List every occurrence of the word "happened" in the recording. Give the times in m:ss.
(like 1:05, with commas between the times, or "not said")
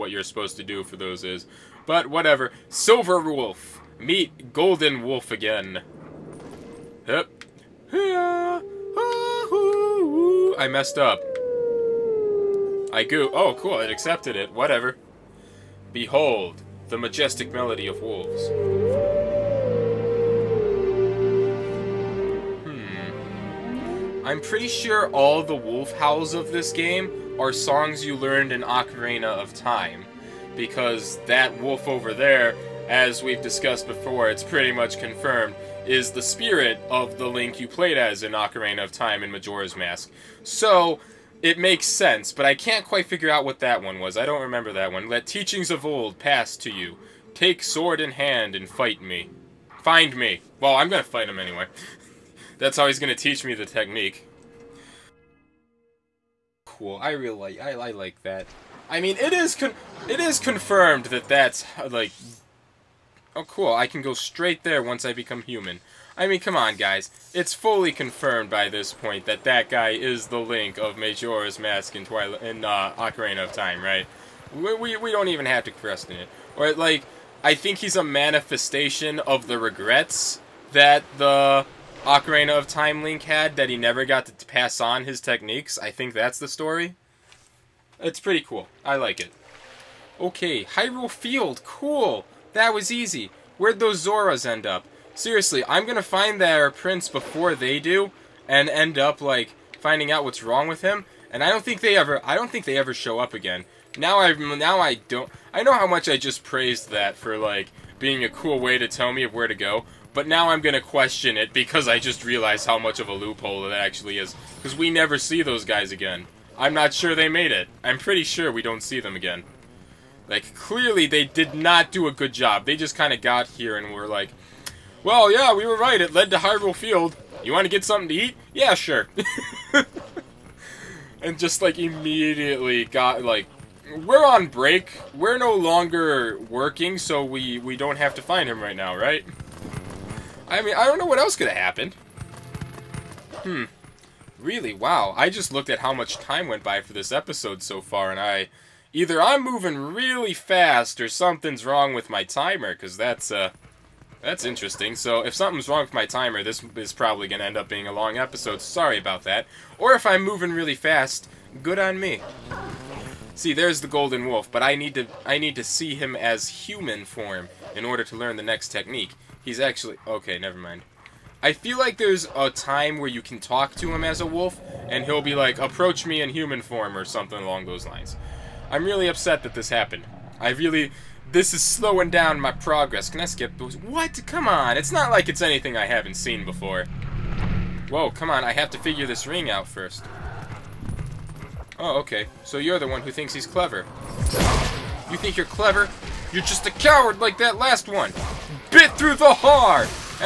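2:21, 2:59.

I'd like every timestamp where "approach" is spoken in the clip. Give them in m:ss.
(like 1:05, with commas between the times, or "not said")
2:55.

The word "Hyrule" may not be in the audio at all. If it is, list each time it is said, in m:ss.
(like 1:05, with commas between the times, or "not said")
1:30, 2:06.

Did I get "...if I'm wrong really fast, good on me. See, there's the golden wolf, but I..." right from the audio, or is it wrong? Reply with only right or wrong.
wrong.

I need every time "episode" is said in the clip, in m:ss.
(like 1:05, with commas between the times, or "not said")
2:27, 2:38.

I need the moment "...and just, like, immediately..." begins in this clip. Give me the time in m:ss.
2:11.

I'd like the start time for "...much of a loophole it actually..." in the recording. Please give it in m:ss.
1:52.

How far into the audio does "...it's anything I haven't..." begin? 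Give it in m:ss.
3:05.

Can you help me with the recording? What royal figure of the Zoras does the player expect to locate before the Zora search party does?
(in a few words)
their prince.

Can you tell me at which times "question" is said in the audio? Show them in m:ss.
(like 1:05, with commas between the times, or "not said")
1:15, 1:50.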